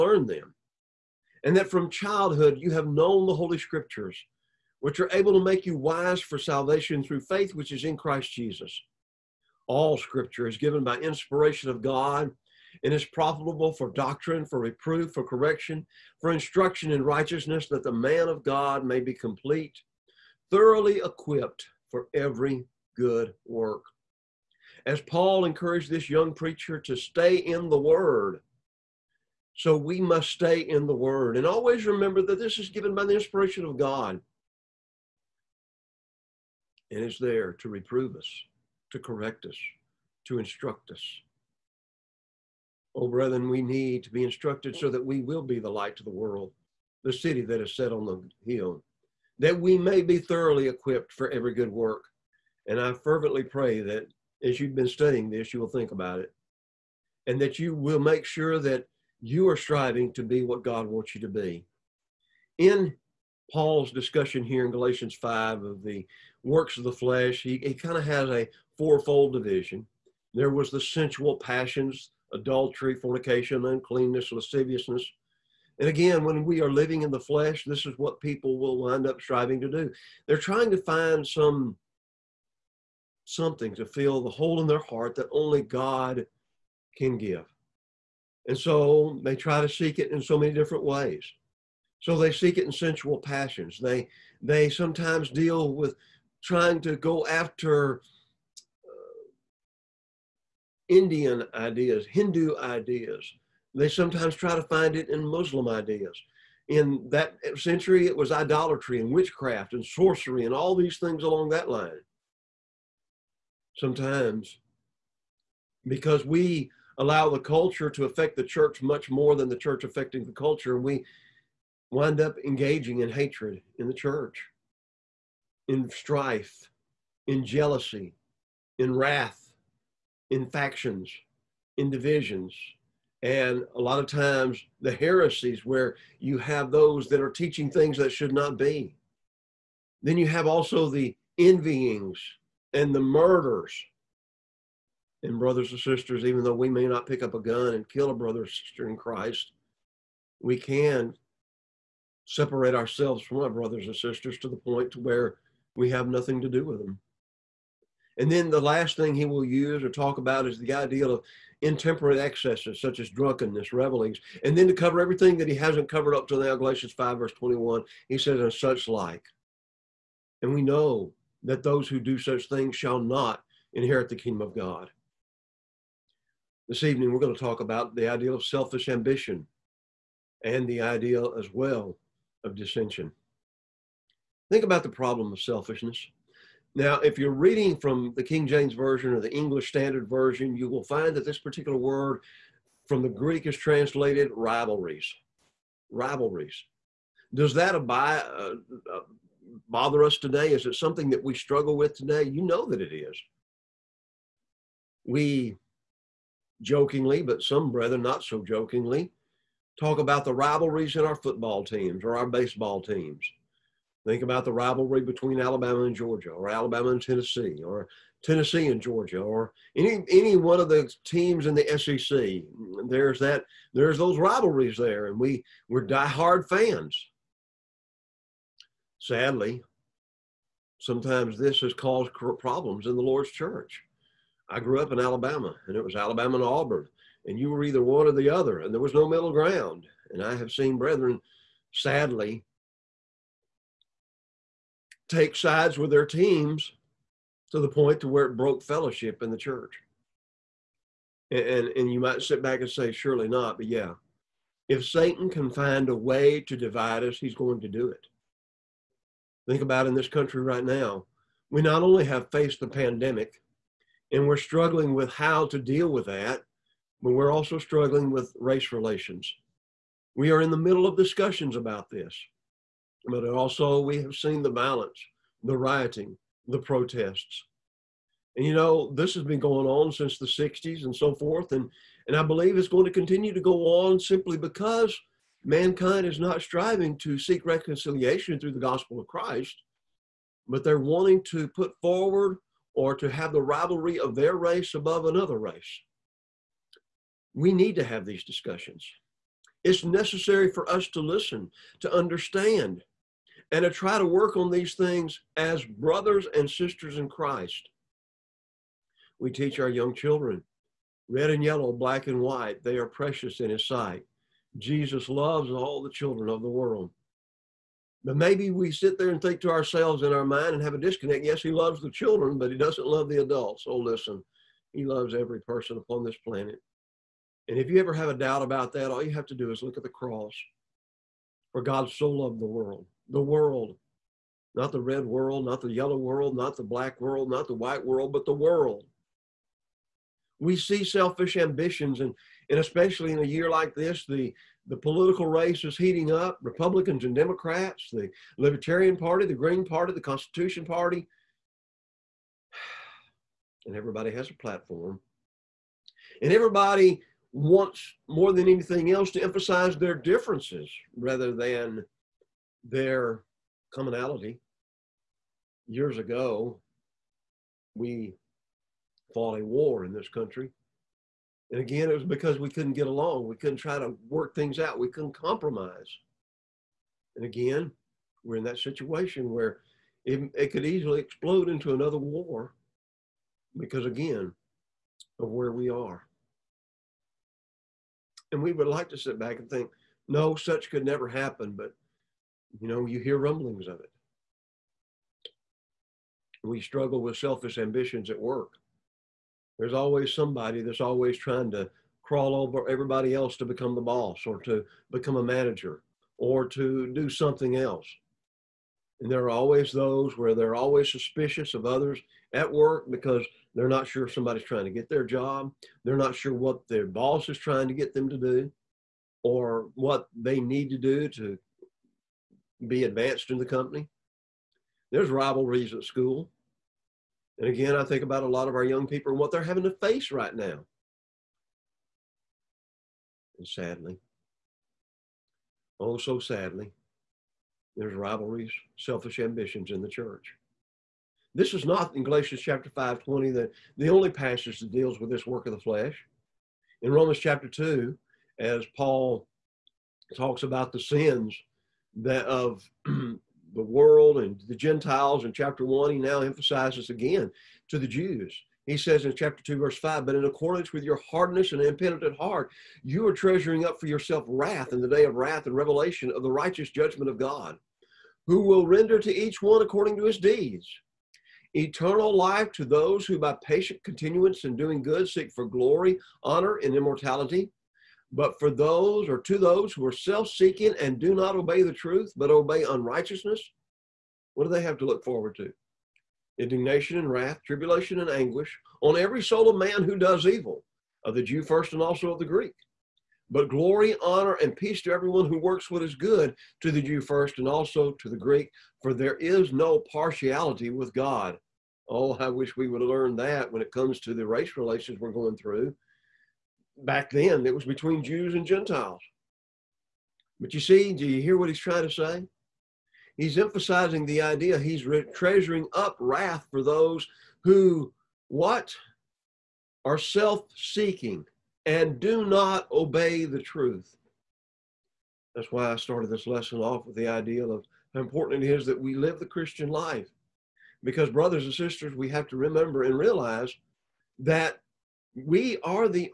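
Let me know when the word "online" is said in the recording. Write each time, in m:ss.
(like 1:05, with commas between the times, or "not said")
not said.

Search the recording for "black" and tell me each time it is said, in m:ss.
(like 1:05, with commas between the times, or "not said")
5:11, 5:36.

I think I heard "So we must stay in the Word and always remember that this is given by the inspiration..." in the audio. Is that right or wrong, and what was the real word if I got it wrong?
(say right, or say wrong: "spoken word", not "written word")
right.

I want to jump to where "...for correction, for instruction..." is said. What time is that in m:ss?
0:15.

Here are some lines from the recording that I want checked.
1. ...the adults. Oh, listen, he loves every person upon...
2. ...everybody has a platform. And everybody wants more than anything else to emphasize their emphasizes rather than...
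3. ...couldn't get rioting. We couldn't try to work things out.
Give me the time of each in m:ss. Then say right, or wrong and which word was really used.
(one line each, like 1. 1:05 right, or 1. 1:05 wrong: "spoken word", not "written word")
1. 5:23 right
2. 5:53 wrong: "differences", not "emphasizes"
3. 6:12 wrong: "along", not "rioting".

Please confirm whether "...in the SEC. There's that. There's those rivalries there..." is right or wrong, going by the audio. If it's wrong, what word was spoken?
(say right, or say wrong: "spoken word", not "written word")
right.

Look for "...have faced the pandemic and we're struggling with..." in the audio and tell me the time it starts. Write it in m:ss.
4:22.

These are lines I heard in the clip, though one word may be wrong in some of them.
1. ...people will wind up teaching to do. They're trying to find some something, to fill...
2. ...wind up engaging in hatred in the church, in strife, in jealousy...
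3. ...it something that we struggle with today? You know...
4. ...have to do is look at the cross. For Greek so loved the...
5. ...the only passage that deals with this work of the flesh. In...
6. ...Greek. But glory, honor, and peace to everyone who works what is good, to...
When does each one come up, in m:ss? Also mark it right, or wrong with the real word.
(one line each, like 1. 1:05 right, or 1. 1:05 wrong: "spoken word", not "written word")
1. 1:18 wrong: "striving", not "teaching"
2. 2:01 right
3. 3:20 right
4. 5:29 wrong: "God", not "Greek"
5. 7:23 right
6. 8:12 right.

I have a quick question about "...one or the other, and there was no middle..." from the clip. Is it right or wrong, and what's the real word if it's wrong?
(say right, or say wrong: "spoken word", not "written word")
right.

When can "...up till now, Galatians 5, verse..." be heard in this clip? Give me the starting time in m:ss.
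2:46.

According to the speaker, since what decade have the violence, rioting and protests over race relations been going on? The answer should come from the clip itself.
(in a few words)
the 60s.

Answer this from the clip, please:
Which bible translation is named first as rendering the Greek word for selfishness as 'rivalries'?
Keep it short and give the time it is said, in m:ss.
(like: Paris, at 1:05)
King James Version, at 3:08.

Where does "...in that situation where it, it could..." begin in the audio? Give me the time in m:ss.
6:18.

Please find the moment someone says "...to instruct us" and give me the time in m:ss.
0:40.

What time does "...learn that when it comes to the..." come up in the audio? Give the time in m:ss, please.
8:22.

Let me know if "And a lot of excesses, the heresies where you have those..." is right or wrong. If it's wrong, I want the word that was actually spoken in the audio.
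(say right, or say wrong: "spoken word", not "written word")
wrong: "times", not "excesses".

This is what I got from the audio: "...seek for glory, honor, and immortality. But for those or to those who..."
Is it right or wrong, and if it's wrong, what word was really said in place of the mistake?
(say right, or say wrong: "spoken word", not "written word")
right.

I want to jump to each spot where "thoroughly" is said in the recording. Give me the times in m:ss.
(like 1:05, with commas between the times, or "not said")
0:20, 0:50.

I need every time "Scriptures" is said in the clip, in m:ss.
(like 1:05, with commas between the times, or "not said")
0:03, 0:09.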